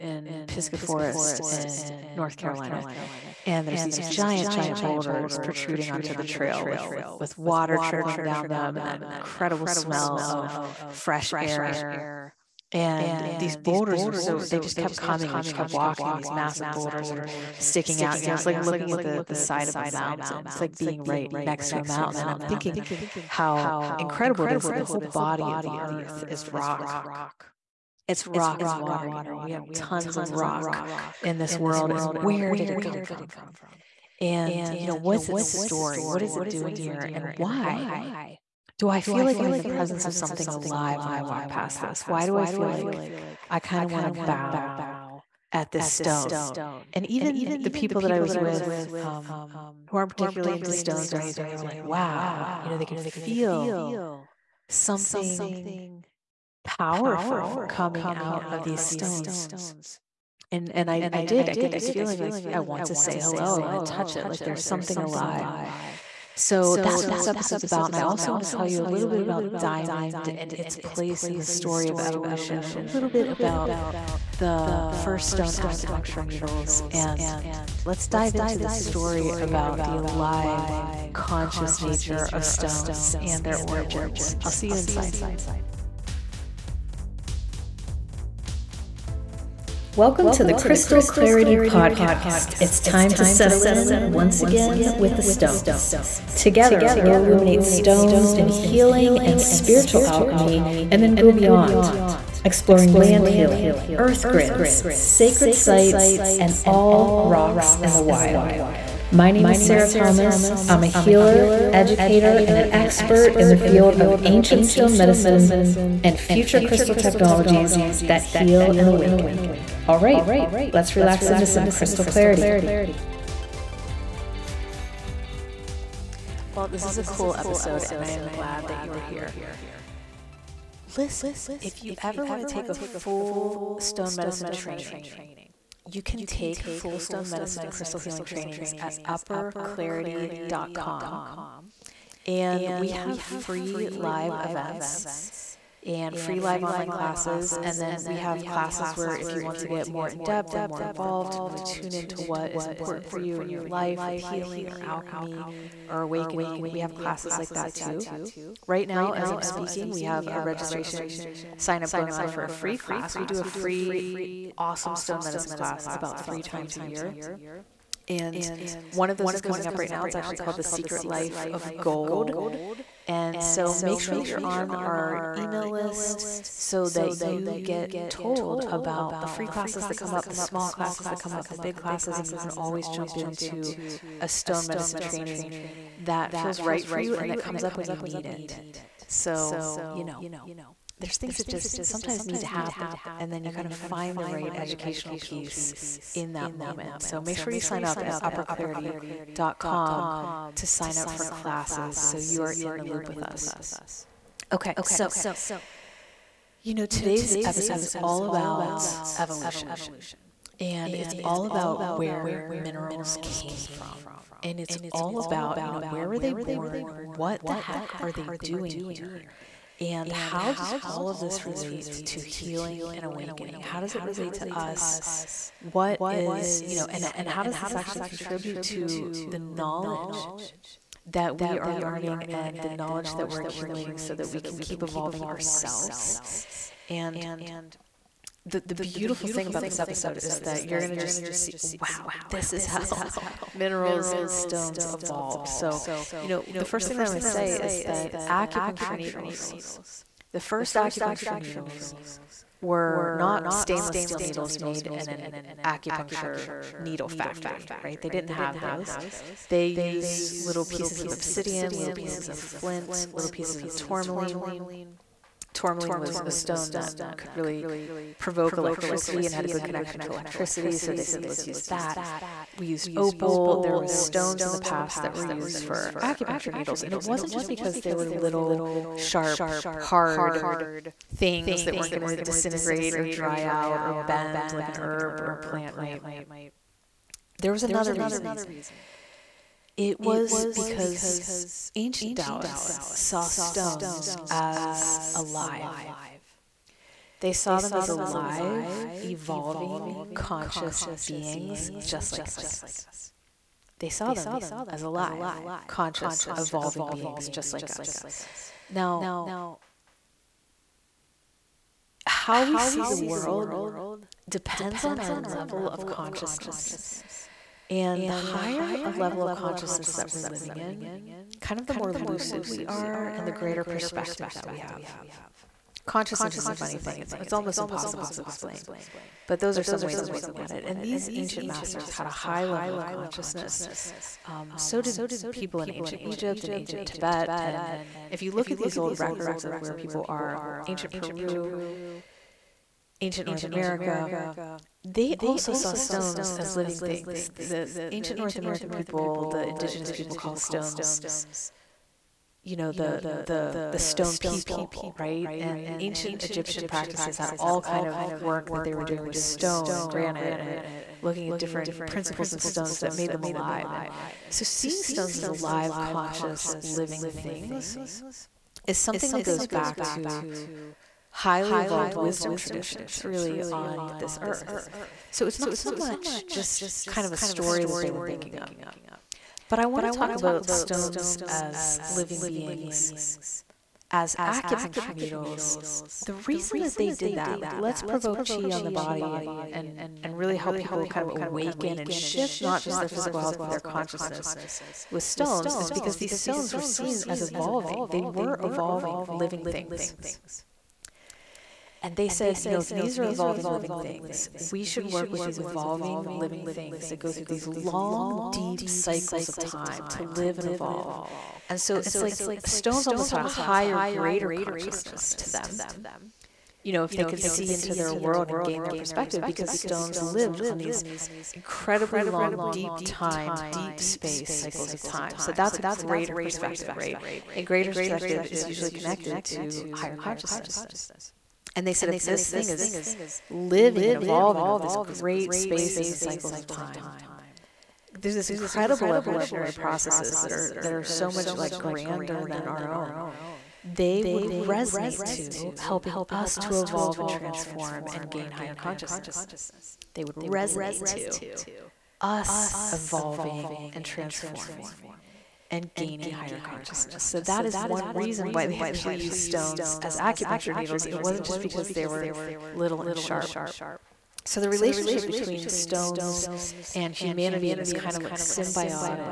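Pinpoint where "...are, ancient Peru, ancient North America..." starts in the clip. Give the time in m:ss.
5:40.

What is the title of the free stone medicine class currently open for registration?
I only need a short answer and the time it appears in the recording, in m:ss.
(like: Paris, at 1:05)
The Secret Life of Gold, at 2:50.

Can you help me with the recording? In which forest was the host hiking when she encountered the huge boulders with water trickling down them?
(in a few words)
Pisgah Forest.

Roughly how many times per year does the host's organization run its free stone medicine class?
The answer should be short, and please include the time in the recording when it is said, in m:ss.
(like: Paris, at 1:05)
3 times, at 2:46.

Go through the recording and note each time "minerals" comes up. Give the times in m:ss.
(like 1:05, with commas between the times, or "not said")
3:32, 4:03.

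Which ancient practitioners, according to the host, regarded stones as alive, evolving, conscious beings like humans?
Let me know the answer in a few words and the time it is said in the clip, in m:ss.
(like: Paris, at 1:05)
Taoists, at 4:52.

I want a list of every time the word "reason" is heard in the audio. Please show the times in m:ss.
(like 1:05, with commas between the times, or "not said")
4:47, 6:26, 7:37.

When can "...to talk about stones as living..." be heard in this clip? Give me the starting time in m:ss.
6:19.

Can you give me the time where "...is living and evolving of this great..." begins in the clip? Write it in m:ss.
7:12.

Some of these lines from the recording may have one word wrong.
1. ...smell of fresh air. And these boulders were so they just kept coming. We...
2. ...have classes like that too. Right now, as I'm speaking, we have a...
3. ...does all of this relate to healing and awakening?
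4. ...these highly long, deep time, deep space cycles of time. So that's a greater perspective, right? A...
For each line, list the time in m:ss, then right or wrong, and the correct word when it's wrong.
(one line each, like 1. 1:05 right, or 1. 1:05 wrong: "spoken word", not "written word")
1. 0:09 right
2. 2:36 right
3. 3:40 right
4. 7:00 wrong: "incredibly", not "highly".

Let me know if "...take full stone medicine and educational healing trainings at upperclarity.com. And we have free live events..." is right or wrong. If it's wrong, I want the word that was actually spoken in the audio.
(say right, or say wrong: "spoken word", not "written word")
wrong: "crystal", not "educational".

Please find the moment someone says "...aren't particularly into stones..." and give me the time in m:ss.
0:49.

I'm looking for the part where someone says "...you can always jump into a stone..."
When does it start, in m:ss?
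3:02.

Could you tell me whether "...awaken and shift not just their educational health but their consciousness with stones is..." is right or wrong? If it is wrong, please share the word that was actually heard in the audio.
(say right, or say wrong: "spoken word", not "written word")
wrong: "physical", not "educational".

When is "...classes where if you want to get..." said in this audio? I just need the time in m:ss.
2:28.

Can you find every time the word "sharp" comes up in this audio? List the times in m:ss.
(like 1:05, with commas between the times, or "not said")
4:38, 7:42.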